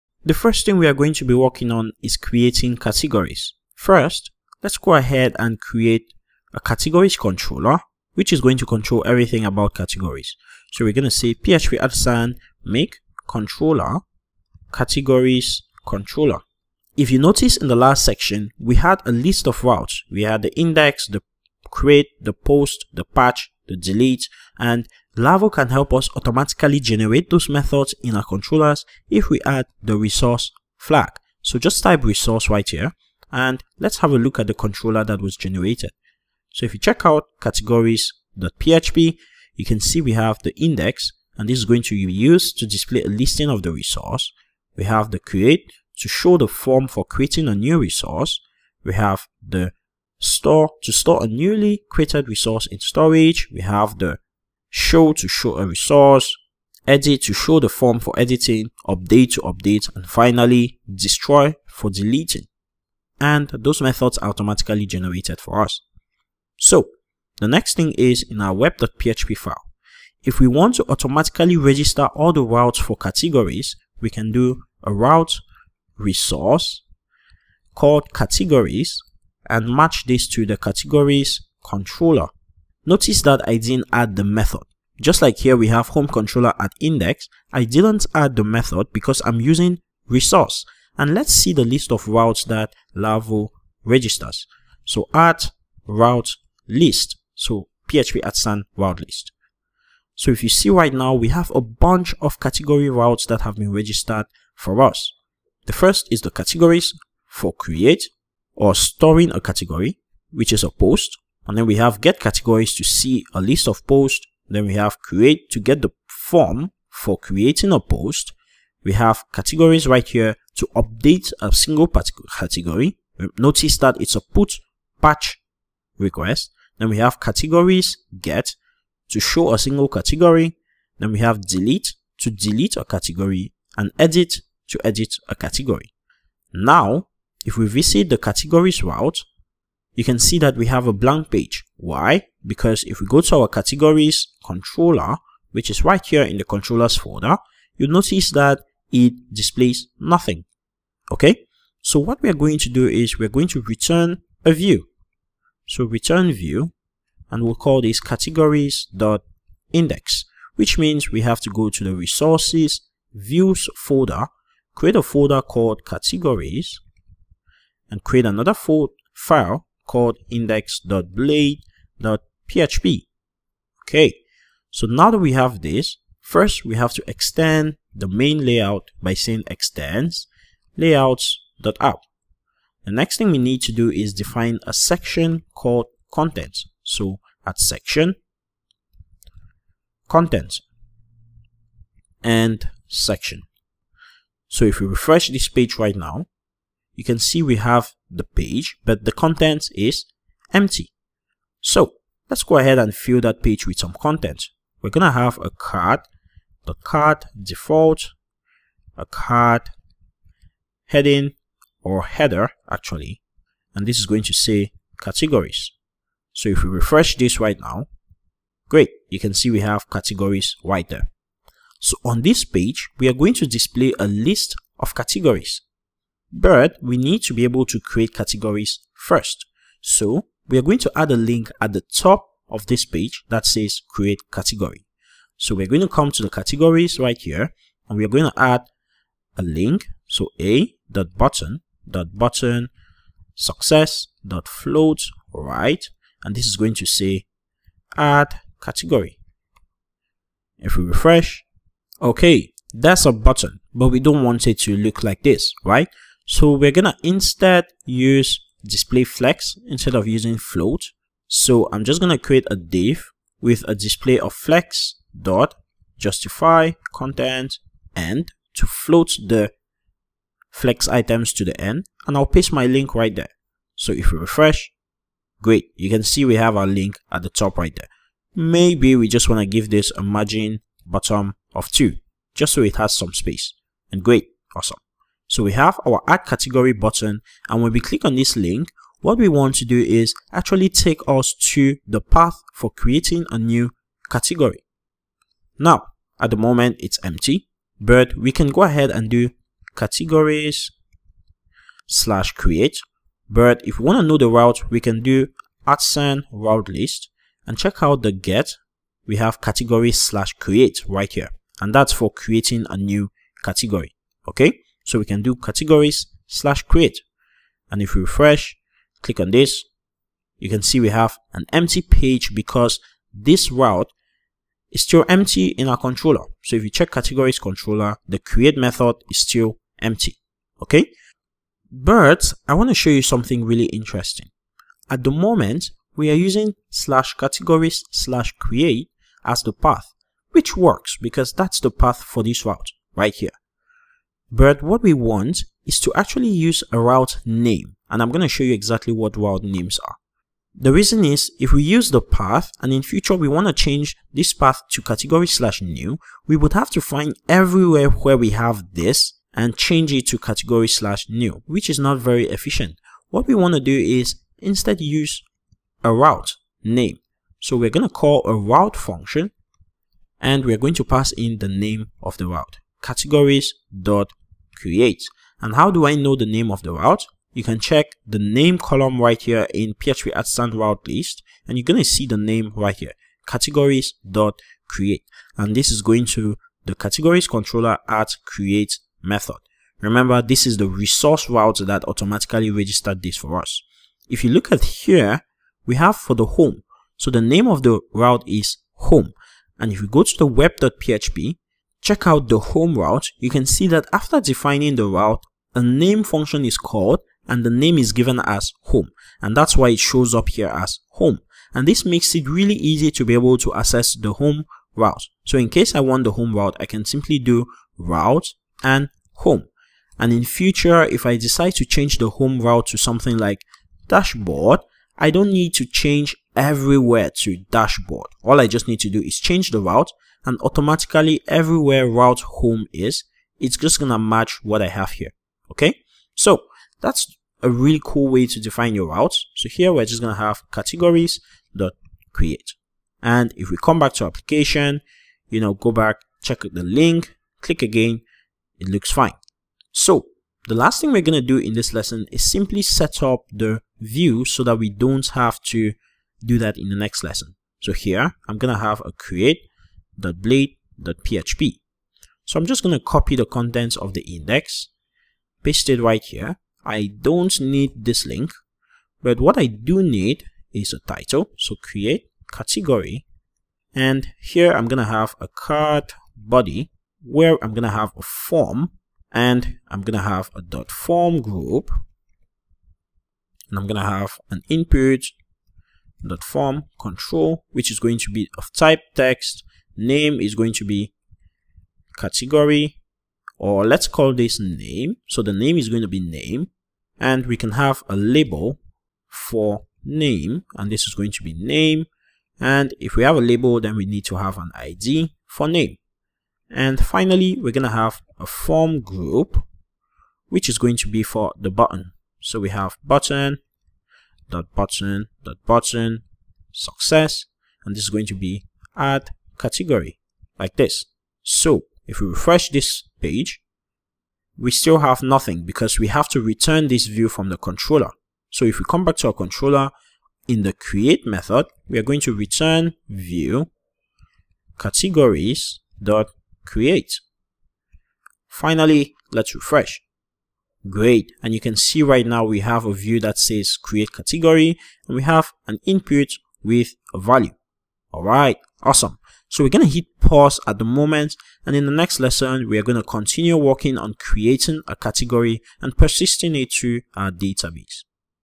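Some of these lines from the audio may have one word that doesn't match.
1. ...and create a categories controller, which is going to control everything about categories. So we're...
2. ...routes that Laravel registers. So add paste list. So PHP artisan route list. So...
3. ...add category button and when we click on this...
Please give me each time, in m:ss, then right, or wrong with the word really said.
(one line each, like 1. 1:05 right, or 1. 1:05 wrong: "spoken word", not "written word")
1. 0:05 right
2. 1:32 wrong: "route", not "paste"
3. 4:46 right.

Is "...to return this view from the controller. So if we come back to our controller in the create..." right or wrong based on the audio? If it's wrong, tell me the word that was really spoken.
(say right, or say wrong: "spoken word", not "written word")
right.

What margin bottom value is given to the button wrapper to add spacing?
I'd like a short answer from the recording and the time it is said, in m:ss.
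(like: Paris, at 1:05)
2, at 4:40.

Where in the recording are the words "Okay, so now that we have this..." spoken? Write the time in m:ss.
2:53.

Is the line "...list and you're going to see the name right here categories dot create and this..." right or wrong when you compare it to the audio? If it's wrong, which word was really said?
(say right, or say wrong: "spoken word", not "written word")
right.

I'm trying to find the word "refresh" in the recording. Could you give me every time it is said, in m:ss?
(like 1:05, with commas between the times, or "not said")
3:14, 3:36, 4:10, 4:34, 5:18, 8:42, 8:59.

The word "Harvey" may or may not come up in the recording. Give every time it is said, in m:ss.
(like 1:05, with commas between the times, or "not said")
not said.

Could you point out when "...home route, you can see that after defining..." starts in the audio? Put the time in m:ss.
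6:42.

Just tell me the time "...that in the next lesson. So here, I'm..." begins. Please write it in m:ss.
7:36.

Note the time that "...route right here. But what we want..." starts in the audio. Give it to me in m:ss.
5:42.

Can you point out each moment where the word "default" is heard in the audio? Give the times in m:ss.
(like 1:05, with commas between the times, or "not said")
3:27.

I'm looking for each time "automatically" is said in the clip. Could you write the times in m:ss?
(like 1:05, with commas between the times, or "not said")
0:26, 1:04, 1:10, 6:31, 7:10.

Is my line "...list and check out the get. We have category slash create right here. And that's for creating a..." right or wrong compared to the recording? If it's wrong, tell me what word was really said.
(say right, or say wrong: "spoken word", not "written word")
right.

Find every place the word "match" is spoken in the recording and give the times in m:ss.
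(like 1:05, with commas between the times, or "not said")
1:19, 7:13.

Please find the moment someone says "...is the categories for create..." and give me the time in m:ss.
1:46.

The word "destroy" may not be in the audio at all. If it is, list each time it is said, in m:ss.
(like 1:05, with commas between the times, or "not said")
1:00.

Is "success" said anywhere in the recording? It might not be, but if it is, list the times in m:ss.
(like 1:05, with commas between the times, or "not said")
4:03, 8:36.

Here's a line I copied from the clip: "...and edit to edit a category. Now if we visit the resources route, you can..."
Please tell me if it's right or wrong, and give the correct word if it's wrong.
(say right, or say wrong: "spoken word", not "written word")
wrong: "categories", not "resources".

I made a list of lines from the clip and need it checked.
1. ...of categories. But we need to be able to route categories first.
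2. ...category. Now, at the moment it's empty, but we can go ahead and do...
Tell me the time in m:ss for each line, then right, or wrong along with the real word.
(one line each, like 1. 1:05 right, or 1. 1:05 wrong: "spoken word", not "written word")
1. 3:44 wrong: "create", not "route"
2. 4:54 right.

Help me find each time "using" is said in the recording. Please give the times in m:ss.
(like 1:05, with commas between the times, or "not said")
1:29, 4:20, 5:36.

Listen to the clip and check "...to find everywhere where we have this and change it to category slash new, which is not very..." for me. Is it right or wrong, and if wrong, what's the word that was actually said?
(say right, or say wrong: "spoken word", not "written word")
right.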